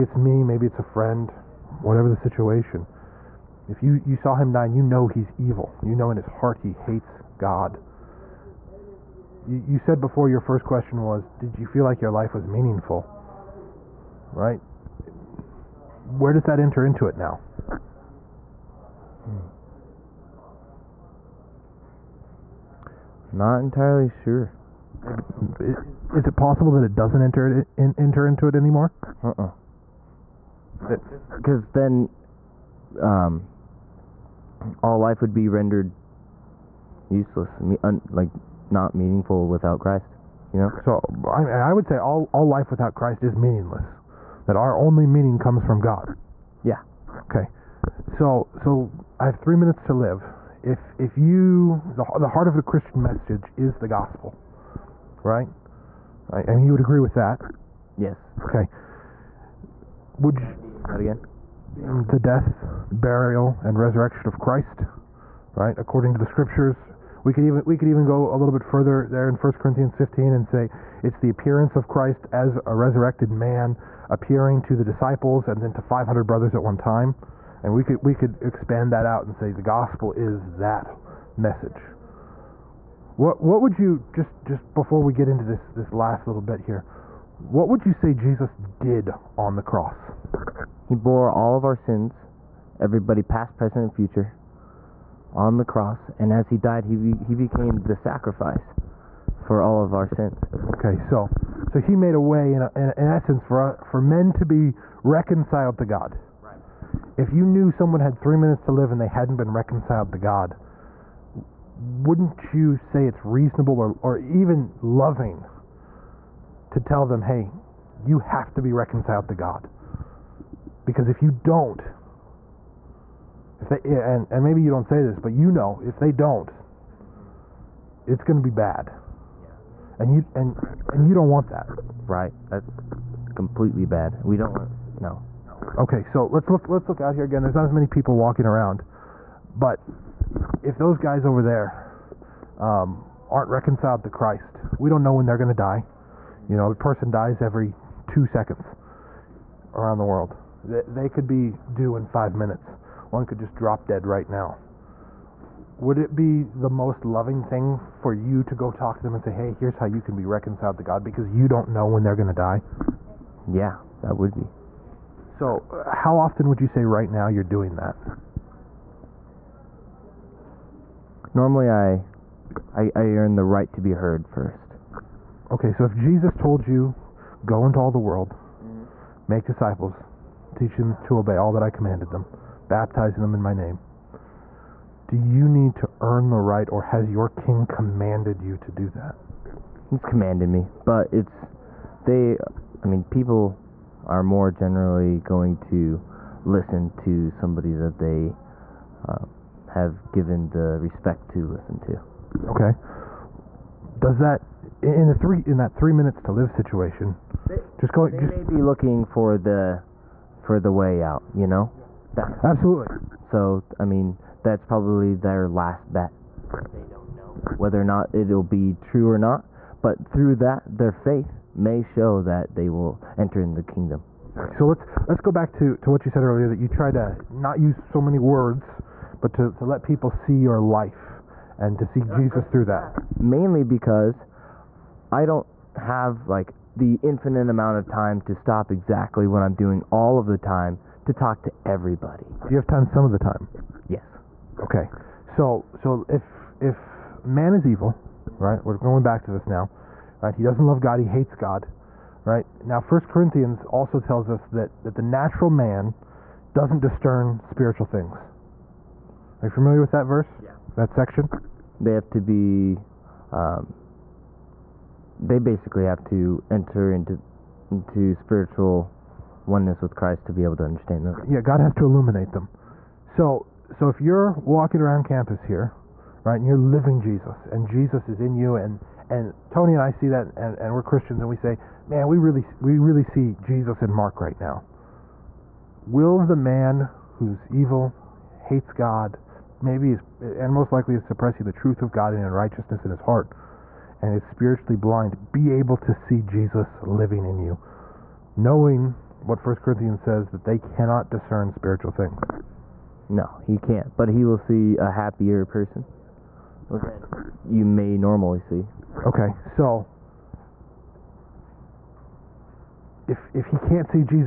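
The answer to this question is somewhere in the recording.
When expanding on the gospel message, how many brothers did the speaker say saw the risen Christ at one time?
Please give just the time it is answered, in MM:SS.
01:15.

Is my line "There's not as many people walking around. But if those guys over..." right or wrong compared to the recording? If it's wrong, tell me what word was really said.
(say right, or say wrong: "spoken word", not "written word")
right.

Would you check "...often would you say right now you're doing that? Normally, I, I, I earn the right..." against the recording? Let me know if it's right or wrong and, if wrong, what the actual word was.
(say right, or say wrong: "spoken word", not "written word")
right.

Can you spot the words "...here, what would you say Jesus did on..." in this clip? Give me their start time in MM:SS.
01:26.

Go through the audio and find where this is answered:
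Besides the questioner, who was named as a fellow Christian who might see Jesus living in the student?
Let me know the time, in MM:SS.
04:39.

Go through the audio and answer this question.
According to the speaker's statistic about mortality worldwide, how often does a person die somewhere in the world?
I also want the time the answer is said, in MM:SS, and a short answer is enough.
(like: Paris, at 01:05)
every 2 seconds, at 02:27.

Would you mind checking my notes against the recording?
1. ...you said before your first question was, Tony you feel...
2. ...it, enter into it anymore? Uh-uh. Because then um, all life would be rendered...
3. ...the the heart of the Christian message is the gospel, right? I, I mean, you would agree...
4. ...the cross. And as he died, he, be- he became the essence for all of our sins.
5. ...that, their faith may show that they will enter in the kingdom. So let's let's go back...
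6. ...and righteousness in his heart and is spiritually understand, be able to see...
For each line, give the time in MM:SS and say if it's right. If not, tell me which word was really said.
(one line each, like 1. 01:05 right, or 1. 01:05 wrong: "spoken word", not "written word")
1. 00:09 wrong: "Did", not "Tony"
2. 00:27 right
3. 00:51 right
4. 01:35 wrong: "sacrifice", not "essence"
5. 03:40 right
6. 04:52 wrong: "blind", not "understand".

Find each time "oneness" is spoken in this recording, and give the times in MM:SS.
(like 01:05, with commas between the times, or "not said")
04:29.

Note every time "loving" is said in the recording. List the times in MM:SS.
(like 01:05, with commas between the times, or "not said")
01:54, 02:37.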